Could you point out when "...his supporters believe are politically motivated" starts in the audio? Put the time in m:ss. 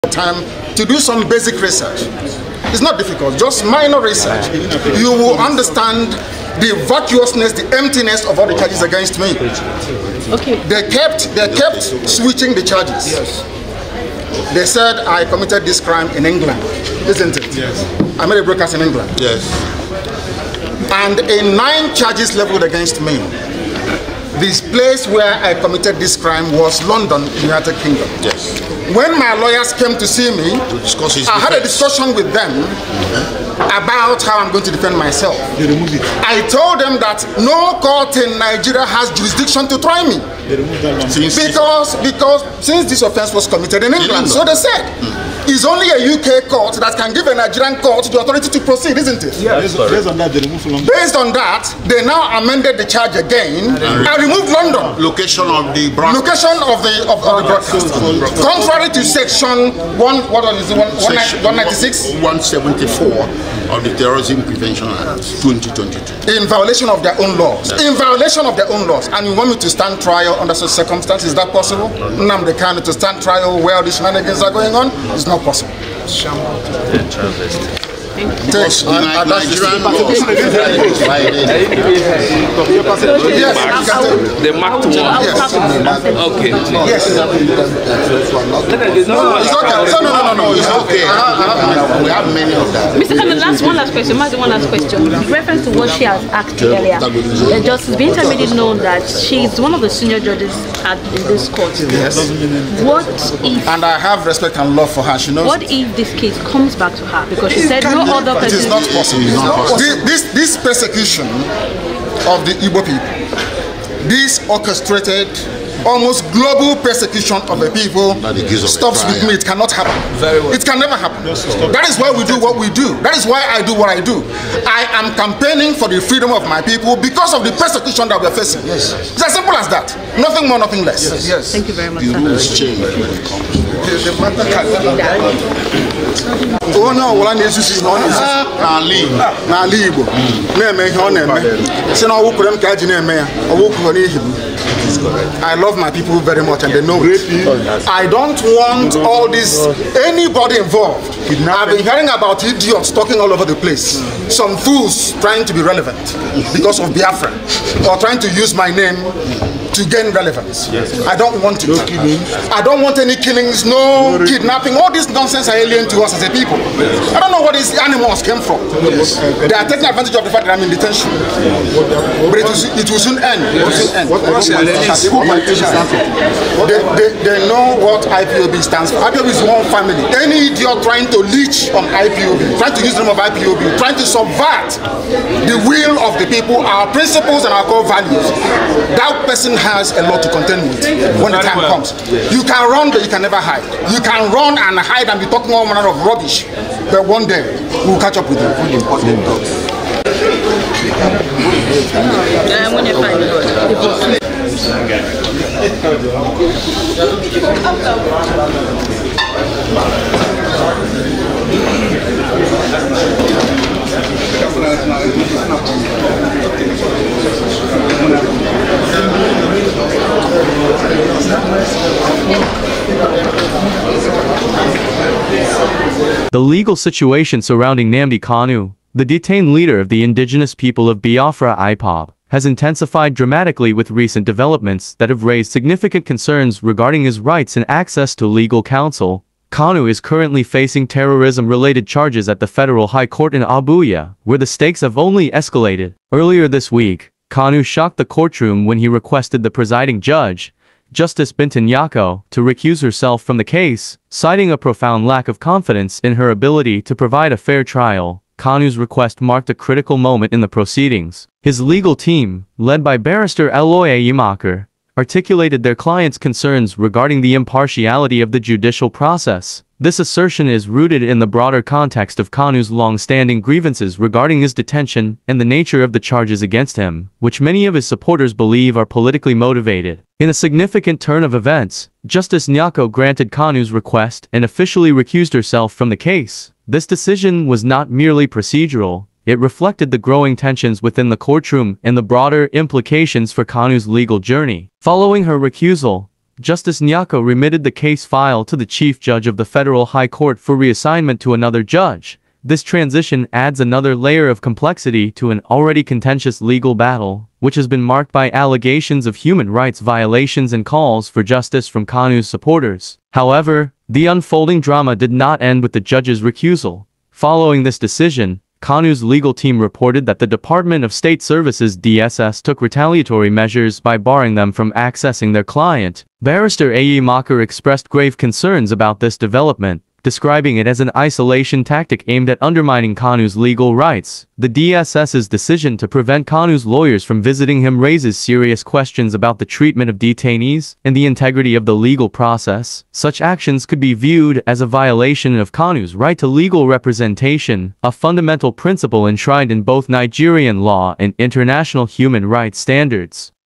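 4:37.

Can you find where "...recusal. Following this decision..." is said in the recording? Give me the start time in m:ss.
5:16.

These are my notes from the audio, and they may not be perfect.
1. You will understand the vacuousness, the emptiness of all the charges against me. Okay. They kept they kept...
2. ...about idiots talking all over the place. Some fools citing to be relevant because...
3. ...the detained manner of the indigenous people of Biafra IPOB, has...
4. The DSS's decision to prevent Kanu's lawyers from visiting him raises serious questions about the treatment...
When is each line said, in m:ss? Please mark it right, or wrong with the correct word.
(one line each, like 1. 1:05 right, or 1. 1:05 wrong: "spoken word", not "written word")
1. 0:04 right
2. 2:32 wrong: "trying", not "citing"
3. 3:48 wrong: "leader", not "manner"
4. 5:34 right.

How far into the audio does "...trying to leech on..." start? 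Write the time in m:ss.
3:00.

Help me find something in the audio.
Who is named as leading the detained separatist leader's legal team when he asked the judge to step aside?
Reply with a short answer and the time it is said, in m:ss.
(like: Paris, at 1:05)
Aloy Ejimakor, at 4:23.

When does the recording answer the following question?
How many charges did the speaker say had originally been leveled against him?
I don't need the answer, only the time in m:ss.
0:21.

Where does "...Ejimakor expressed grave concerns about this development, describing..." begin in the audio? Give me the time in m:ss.
5:26.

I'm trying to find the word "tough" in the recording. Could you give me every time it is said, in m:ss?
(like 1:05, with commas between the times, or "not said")
not said.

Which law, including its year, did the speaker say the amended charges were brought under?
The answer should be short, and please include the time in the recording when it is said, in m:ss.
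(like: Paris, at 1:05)
Terrorism Prevention Act 2022, at 1:03.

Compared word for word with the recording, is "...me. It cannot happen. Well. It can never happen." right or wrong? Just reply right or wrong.
right.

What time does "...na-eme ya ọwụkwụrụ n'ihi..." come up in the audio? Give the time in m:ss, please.
2:22.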